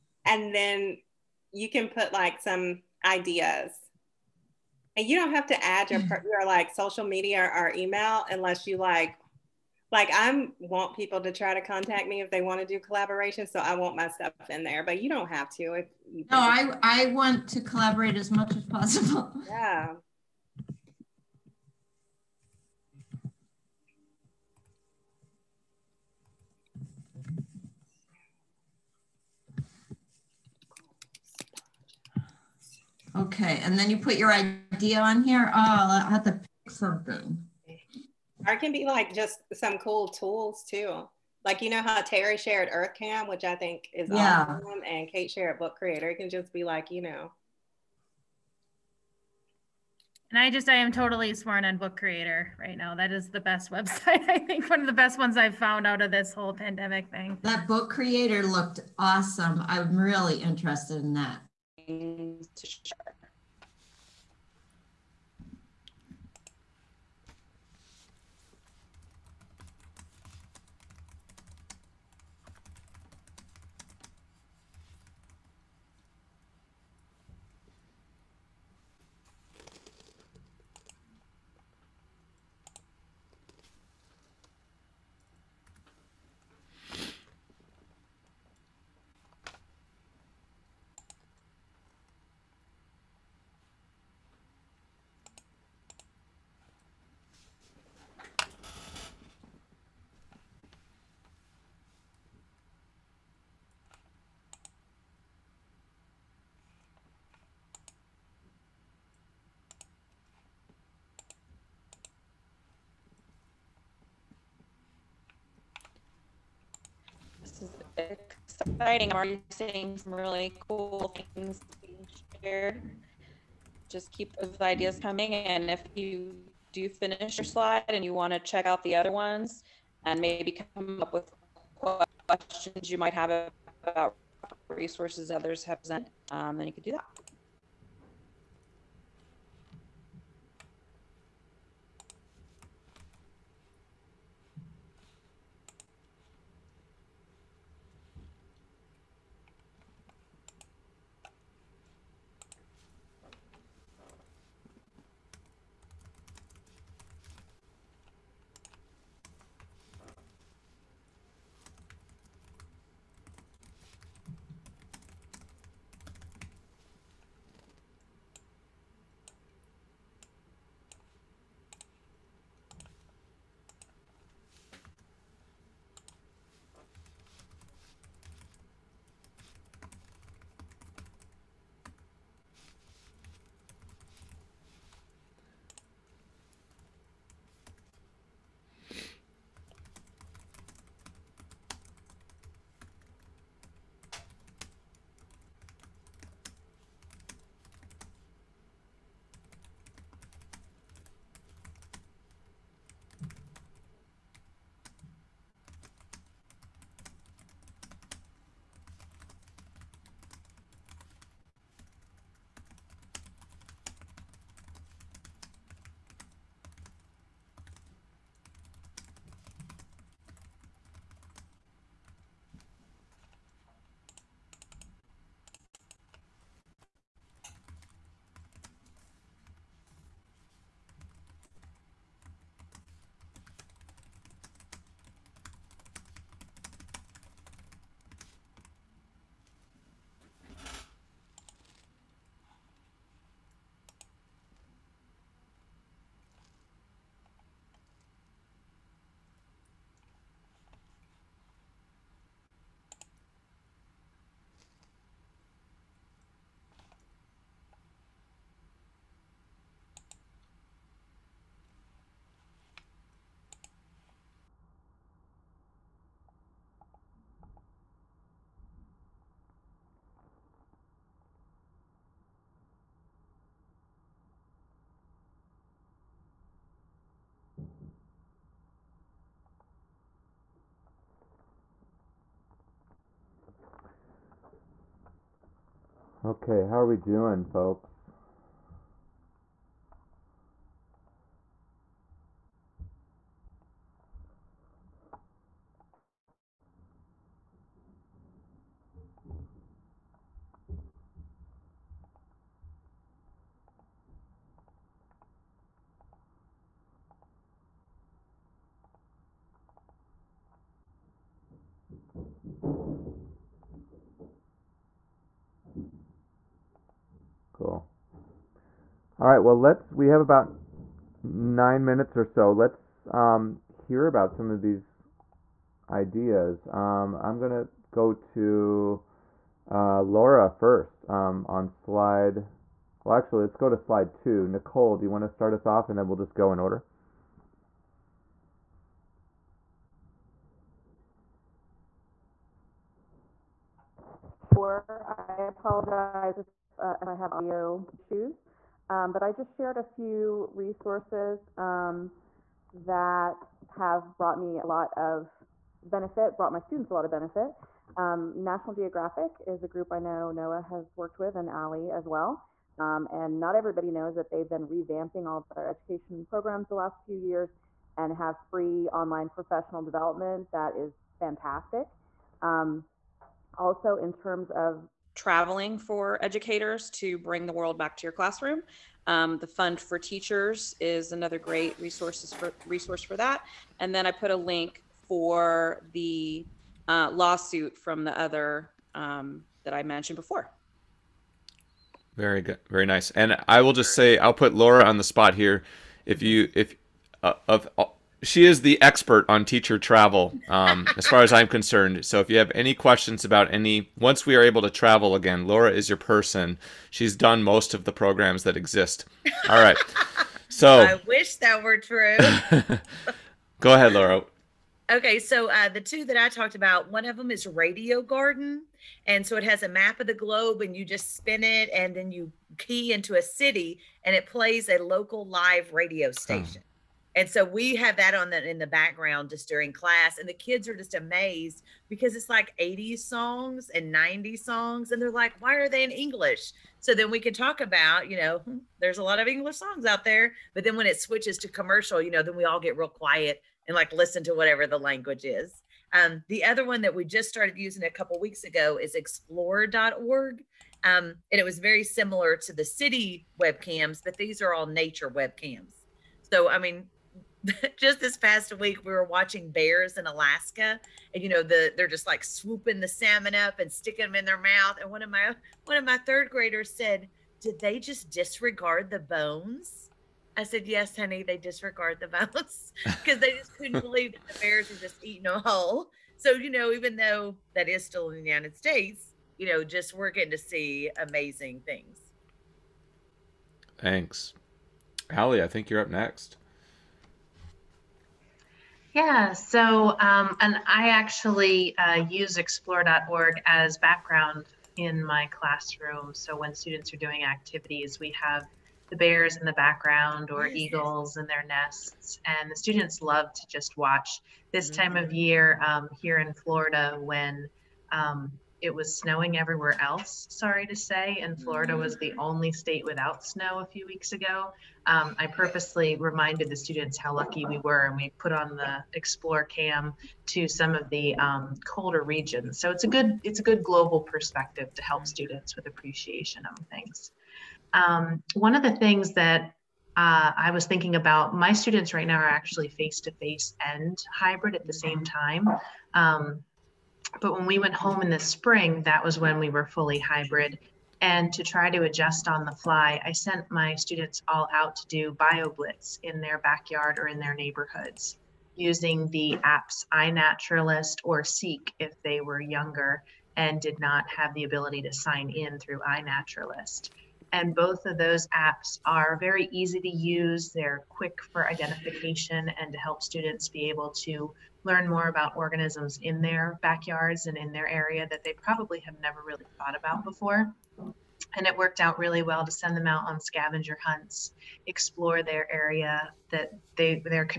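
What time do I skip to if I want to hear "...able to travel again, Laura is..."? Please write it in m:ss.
6:44.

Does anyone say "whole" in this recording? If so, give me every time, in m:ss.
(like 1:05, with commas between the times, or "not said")
0:56, 7:55.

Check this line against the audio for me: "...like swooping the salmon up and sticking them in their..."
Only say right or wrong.
right.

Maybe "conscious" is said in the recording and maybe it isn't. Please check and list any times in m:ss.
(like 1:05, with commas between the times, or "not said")
not said.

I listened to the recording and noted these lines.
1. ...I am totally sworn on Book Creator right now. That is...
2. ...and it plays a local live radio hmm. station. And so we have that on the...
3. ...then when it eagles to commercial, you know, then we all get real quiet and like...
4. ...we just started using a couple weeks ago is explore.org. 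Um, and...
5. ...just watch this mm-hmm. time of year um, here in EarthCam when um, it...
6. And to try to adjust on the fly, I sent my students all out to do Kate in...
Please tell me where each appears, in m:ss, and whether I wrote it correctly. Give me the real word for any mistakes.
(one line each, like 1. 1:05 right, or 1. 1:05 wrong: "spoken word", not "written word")
1. 0:50 right
2. 7:04 right
3. 7:20 wrong: "switches", not "eagles"
4. 7:26 right
5. 8:23 wrong: "Florida", not "EarthCam"
6. 9:01 wrong: "BioBlitz", not "Kate".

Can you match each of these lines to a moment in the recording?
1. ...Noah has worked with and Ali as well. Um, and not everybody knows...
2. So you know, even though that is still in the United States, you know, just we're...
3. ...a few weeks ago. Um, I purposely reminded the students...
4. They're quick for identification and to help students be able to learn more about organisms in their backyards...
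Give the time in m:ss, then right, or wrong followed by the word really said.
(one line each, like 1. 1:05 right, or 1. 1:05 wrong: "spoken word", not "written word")
1. 6:00 right
2. 7:56 right
3. 8:33 right
4. 9:20 right.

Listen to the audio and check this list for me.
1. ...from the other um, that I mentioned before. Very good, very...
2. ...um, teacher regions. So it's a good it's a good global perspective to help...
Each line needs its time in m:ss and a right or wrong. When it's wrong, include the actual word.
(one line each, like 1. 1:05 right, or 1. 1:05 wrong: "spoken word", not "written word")
1. 6:27 right
2. 8:41 wrong: "colder", not "teacher".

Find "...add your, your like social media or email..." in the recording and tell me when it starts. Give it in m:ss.
0:05.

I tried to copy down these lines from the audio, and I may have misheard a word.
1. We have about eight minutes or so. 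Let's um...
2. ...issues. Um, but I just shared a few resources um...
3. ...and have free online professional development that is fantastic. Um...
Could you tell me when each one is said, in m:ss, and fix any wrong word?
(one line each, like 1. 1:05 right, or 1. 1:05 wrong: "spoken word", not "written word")
1. 5:19 wrong: "nine", not "eight"
2. 5:47 right
3. 6:07 right.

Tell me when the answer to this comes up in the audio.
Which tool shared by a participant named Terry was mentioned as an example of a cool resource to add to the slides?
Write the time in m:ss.
0:42.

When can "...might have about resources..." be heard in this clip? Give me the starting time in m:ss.
2:12.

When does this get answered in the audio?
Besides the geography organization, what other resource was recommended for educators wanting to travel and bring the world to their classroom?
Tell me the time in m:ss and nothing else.
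6:19.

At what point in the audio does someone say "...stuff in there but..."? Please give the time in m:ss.
0:14.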